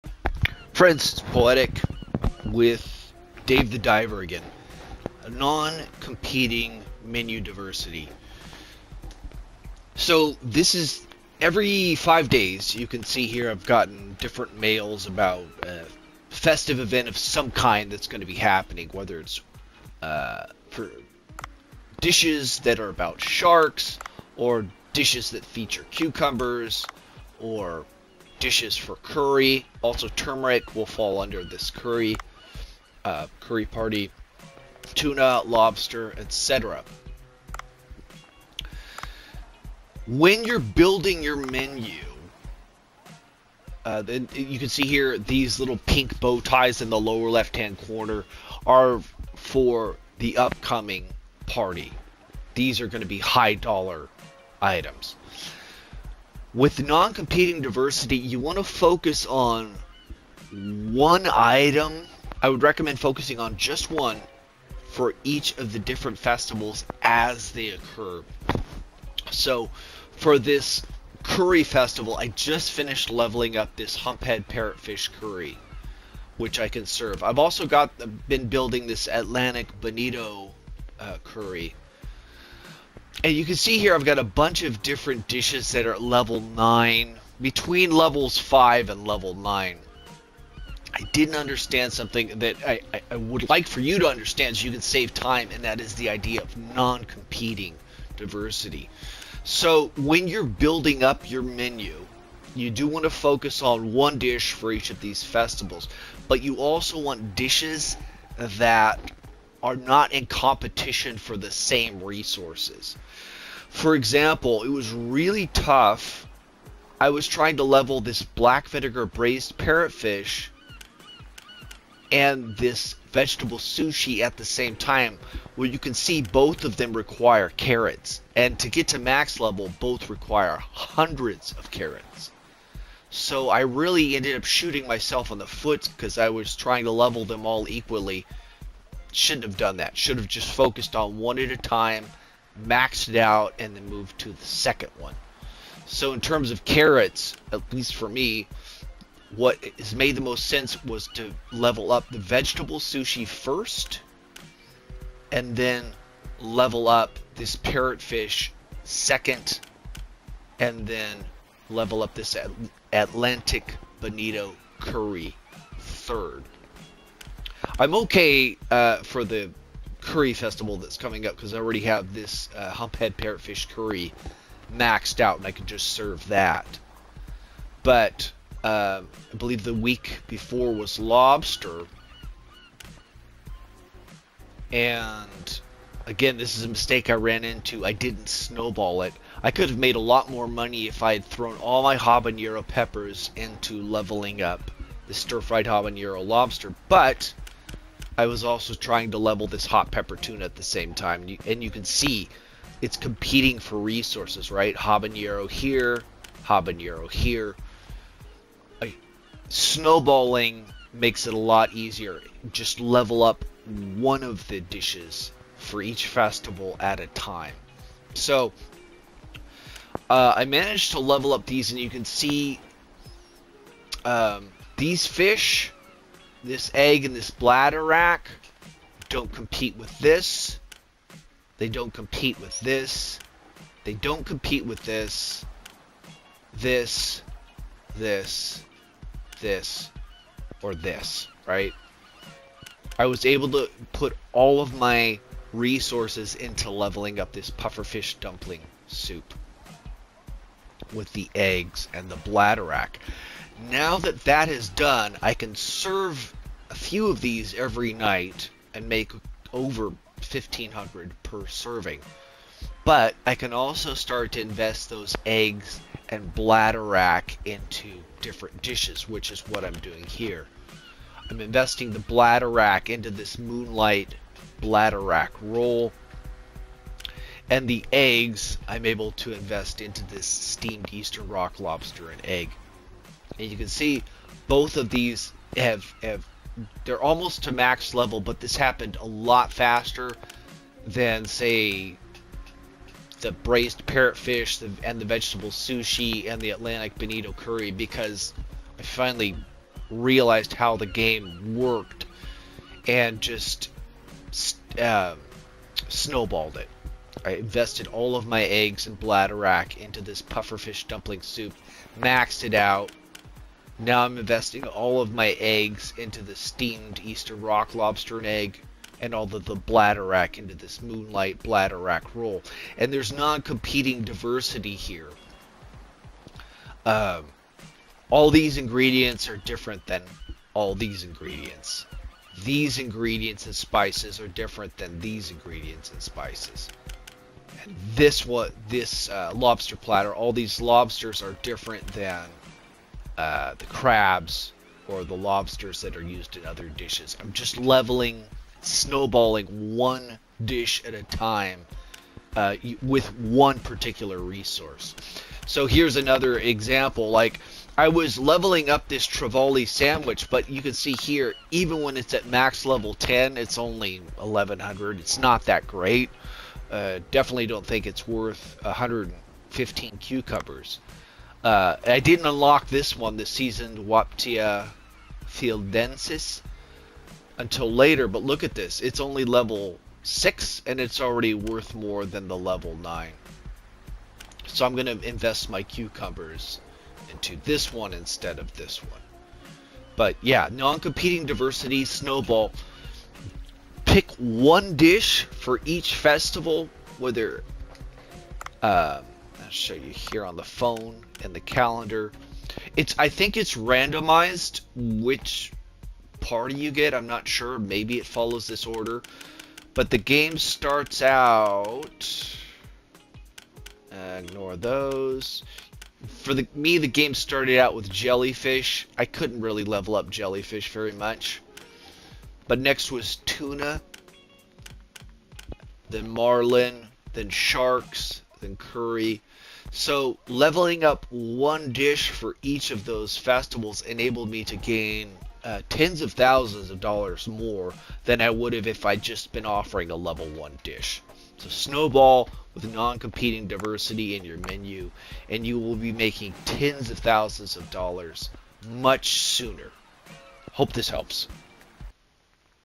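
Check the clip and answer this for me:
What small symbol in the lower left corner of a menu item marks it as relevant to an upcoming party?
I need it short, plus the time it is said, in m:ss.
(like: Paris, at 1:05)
pink bow ties, at 0:45.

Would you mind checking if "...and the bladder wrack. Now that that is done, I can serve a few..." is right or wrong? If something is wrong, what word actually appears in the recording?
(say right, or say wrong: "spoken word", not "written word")
right.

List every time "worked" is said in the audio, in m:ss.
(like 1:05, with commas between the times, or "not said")
5:01.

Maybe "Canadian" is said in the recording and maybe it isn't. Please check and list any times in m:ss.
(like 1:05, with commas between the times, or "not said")
not said.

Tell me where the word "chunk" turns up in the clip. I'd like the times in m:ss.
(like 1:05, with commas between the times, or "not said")
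not said.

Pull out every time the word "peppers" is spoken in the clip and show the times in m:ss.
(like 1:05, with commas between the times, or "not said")
3:12, 3:19.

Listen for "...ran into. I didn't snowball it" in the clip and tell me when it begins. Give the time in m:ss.
3:07.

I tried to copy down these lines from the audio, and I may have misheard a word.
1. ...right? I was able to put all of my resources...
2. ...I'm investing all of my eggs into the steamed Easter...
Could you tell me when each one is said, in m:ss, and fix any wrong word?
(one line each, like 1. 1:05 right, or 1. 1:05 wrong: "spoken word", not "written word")
1. 4:01 right
2. 5:14 right.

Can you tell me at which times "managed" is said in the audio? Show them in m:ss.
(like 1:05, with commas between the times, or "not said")
3:40.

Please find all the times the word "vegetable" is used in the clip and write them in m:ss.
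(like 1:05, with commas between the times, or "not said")
2:03, 2:32, 4:55.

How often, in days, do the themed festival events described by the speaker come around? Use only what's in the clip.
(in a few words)
5.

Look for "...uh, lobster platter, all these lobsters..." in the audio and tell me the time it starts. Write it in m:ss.
5:39.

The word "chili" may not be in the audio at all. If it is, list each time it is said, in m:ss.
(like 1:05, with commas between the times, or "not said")
not said.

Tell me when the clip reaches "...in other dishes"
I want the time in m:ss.
5:46.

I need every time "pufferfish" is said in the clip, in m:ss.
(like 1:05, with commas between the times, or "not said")
4:07, 5:10.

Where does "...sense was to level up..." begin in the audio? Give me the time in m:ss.
2:30.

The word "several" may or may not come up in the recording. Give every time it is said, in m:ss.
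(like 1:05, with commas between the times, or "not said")
not said.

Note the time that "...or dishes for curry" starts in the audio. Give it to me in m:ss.
0:27.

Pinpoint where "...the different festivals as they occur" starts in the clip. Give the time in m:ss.
1:05.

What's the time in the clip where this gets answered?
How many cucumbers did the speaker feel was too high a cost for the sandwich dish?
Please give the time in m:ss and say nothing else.
6:08.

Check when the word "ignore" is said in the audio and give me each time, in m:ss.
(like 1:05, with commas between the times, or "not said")
6:54.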